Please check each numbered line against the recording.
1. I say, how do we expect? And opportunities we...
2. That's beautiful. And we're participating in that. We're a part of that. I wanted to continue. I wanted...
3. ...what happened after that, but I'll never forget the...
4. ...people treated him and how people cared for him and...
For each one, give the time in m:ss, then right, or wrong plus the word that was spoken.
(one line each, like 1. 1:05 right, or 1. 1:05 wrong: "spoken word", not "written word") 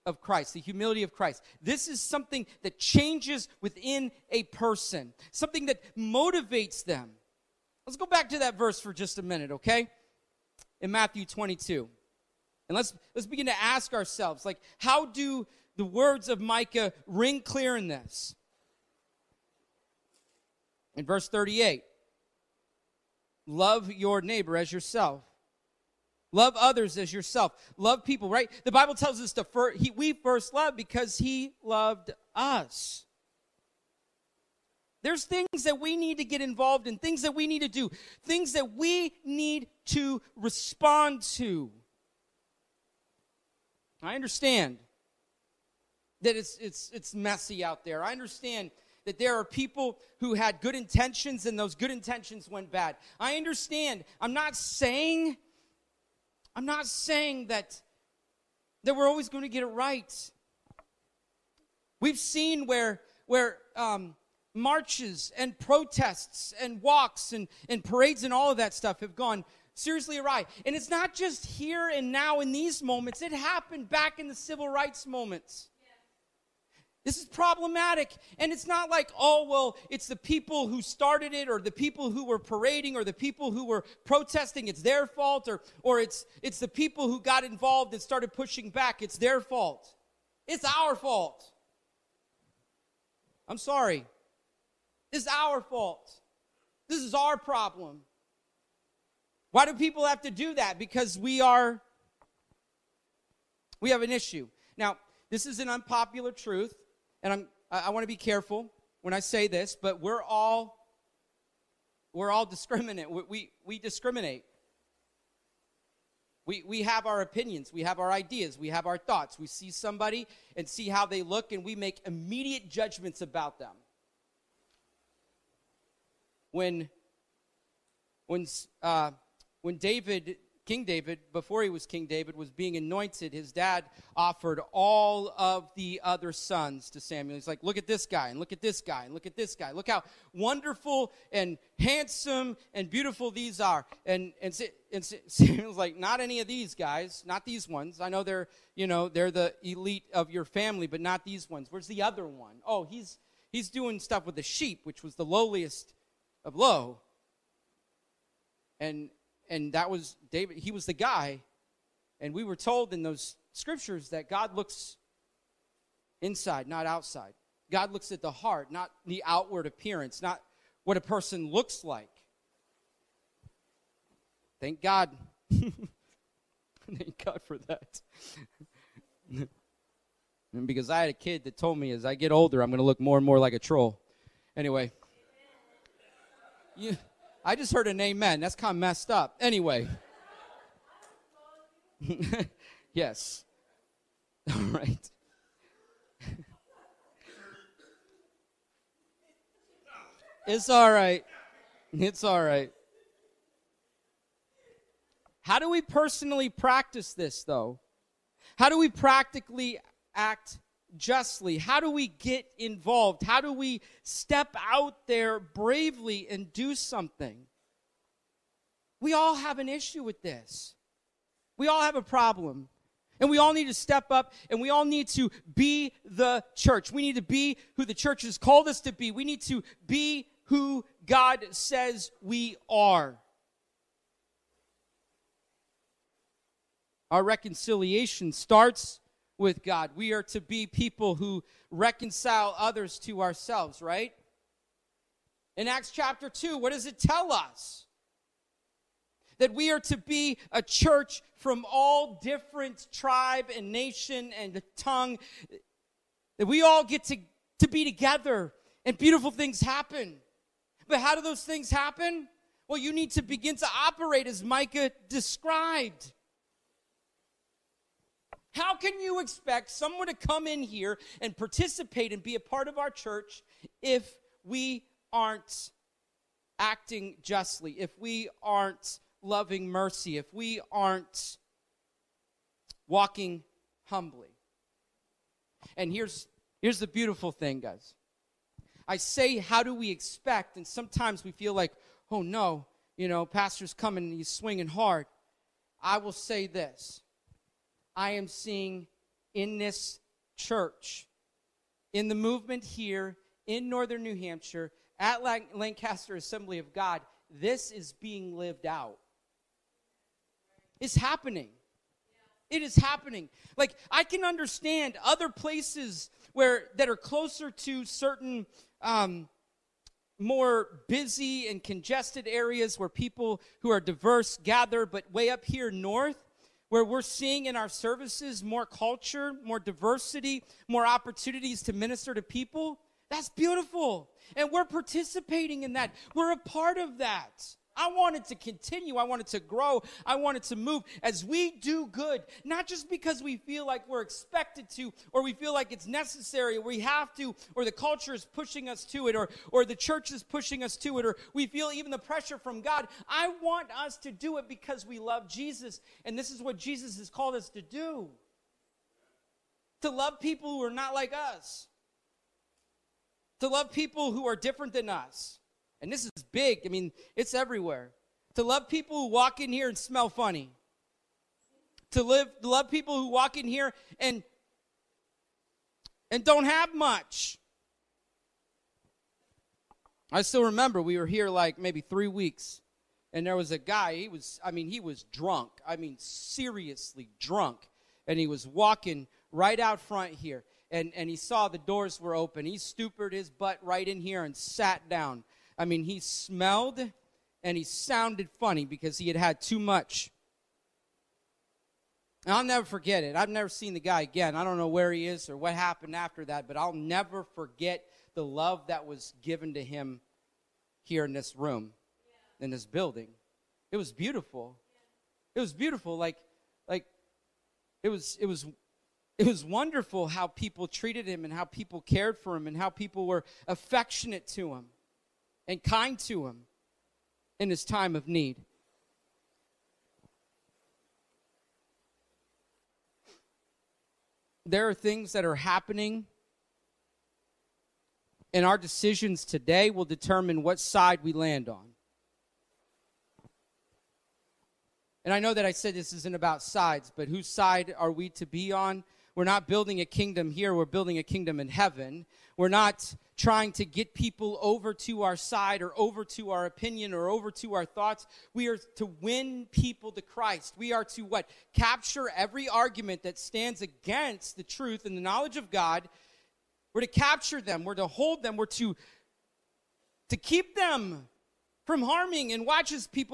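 1. 4:48 wrong: "sometimes", not "opportunities"
2. 5:33 right
3. 6:45 right
4. 7:00 right.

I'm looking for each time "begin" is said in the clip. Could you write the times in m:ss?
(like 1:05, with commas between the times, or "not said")
0:13, 4:23.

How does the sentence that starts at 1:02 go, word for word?
We've seen where, where, um, marches and protests and walks and, and parades and all of that stuff have gone seriously awry.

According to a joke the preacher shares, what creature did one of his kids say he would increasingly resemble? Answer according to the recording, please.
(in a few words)
A troll.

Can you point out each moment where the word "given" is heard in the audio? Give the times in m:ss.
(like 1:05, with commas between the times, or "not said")
6:49.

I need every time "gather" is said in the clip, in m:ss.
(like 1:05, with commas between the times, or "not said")
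5:24.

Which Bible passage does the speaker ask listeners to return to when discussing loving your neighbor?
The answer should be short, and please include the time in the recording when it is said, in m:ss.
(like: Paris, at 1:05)
Matthew 22, at 0:10.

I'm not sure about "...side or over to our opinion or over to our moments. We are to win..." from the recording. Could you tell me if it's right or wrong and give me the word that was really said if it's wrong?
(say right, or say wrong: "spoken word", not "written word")
wrong: "thoughts", not "moments".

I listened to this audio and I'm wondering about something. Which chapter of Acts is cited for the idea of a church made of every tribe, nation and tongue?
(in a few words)
Acts chapter 2.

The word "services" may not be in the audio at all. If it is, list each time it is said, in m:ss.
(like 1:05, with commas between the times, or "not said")
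5:27.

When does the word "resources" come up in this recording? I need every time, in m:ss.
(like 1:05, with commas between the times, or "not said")
not said.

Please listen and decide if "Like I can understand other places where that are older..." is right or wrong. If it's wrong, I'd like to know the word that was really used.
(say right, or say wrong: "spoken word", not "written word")
wrong: "closer", not "older".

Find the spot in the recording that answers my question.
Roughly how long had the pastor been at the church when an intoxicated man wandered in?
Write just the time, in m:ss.
6:21.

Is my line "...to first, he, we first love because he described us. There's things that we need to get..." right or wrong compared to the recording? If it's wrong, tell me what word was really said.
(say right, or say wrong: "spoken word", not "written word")
wrong: "loved", not "described".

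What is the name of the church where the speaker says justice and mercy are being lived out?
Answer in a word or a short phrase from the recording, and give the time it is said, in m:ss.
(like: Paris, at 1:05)
Lancaster Assembly of God, at 5:05.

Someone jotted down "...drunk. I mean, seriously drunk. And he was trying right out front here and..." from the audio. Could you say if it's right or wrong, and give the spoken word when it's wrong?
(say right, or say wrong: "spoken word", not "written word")
wrong: "walking", not "trying".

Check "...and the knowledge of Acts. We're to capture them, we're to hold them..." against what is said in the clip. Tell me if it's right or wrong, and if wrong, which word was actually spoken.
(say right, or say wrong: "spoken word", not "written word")
wrong: "God", not "Acts".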